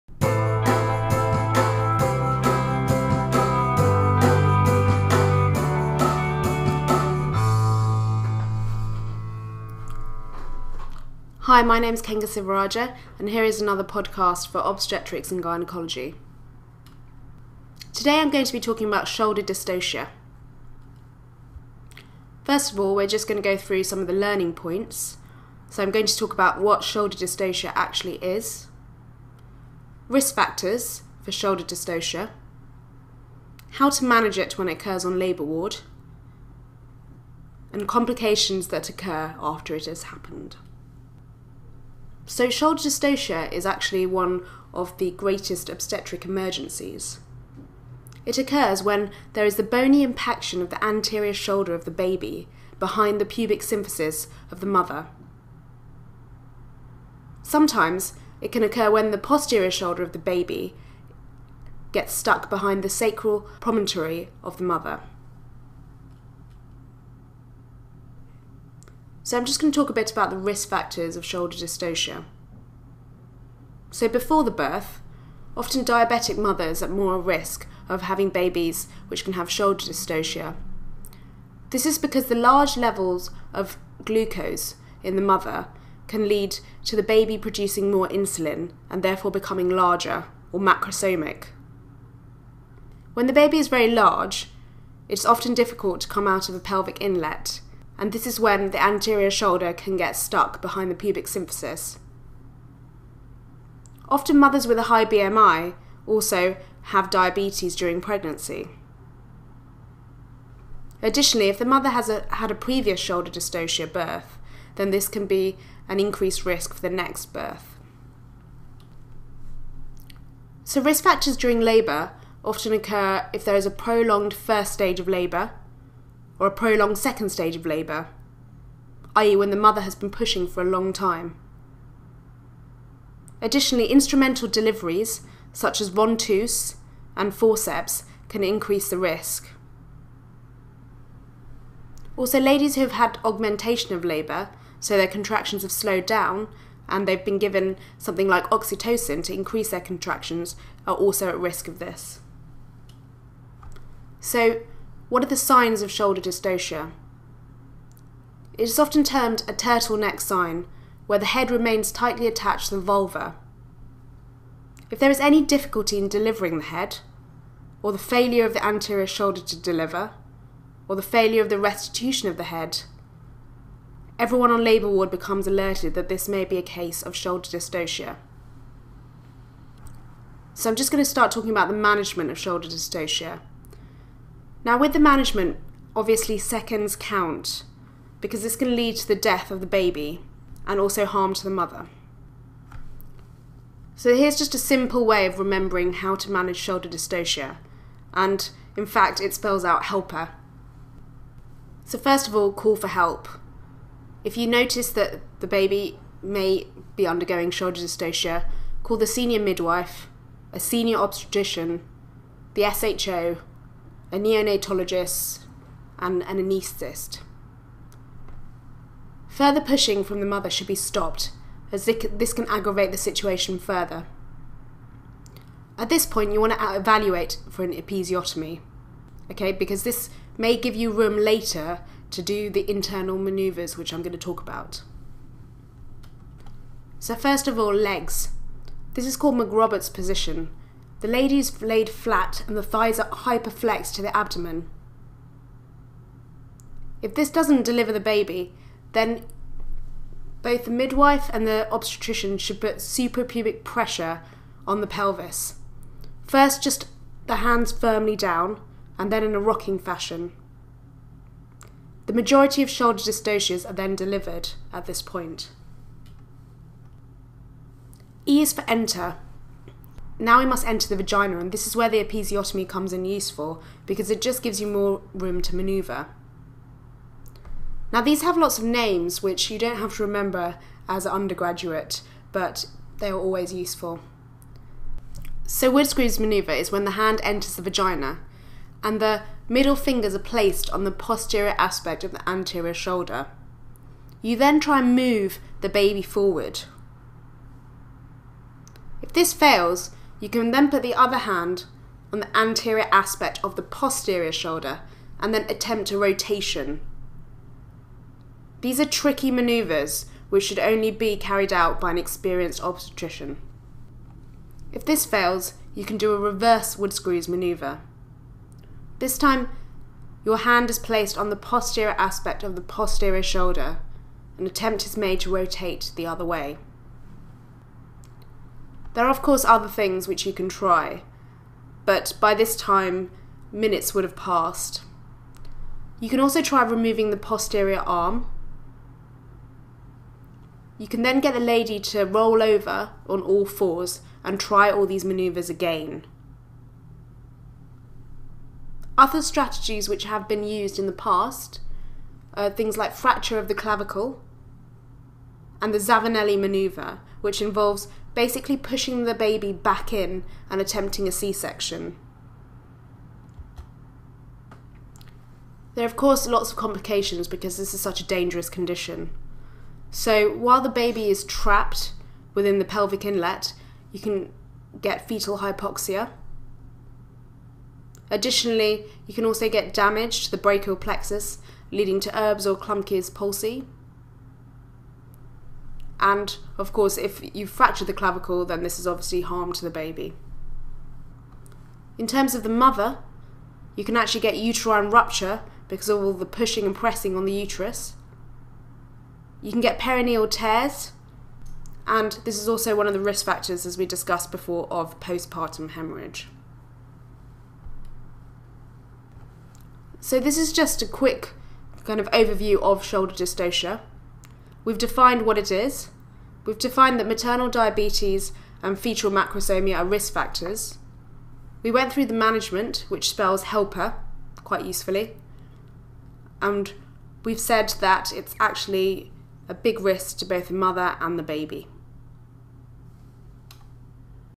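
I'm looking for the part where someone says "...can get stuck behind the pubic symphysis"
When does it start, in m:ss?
1:39.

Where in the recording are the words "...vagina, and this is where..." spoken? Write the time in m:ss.
4:30.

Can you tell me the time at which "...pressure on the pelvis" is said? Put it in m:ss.
4:13.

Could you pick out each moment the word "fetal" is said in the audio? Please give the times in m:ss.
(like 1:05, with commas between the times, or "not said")
6:15, 6:58.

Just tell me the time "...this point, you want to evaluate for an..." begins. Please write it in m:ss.
3:45.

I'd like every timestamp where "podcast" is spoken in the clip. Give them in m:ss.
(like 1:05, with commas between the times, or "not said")
0:13.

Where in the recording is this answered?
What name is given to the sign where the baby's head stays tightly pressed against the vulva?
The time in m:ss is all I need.
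2:39.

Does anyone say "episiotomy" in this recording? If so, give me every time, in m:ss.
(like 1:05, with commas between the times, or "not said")
3:47, 4:32.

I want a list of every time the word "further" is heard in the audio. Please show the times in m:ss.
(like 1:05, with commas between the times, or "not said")
3:39, 3:43.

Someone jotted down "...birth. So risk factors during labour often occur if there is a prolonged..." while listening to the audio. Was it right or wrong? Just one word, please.
right.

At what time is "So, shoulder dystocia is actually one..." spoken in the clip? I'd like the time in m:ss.
0:42.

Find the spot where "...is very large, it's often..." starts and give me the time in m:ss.
1:33.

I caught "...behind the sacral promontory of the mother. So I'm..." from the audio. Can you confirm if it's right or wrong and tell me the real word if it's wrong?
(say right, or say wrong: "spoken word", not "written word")
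right.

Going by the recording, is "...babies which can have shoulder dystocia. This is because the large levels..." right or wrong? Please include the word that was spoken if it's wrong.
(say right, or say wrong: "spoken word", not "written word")
right.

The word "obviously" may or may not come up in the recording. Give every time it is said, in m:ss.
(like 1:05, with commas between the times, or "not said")
3:05, 6:28.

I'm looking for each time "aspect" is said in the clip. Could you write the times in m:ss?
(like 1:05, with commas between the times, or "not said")
4:51, 5:02, 5:21.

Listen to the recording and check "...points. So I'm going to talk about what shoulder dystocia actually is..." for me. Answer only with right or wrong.
right.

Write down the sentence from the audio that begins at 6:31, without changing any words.
In terms of the mother, you can actually get uterine rupture because of all the pushing and pressing on the uterus.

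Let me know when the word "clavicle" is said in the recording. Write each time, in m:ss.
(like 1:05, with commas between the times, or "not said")
5:53, 6:27.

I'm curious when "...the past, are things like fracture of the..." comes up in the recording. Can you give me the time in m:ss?
5:50.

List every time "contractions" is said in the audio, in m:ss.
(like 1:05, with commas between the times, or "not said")
2:25, 2:29.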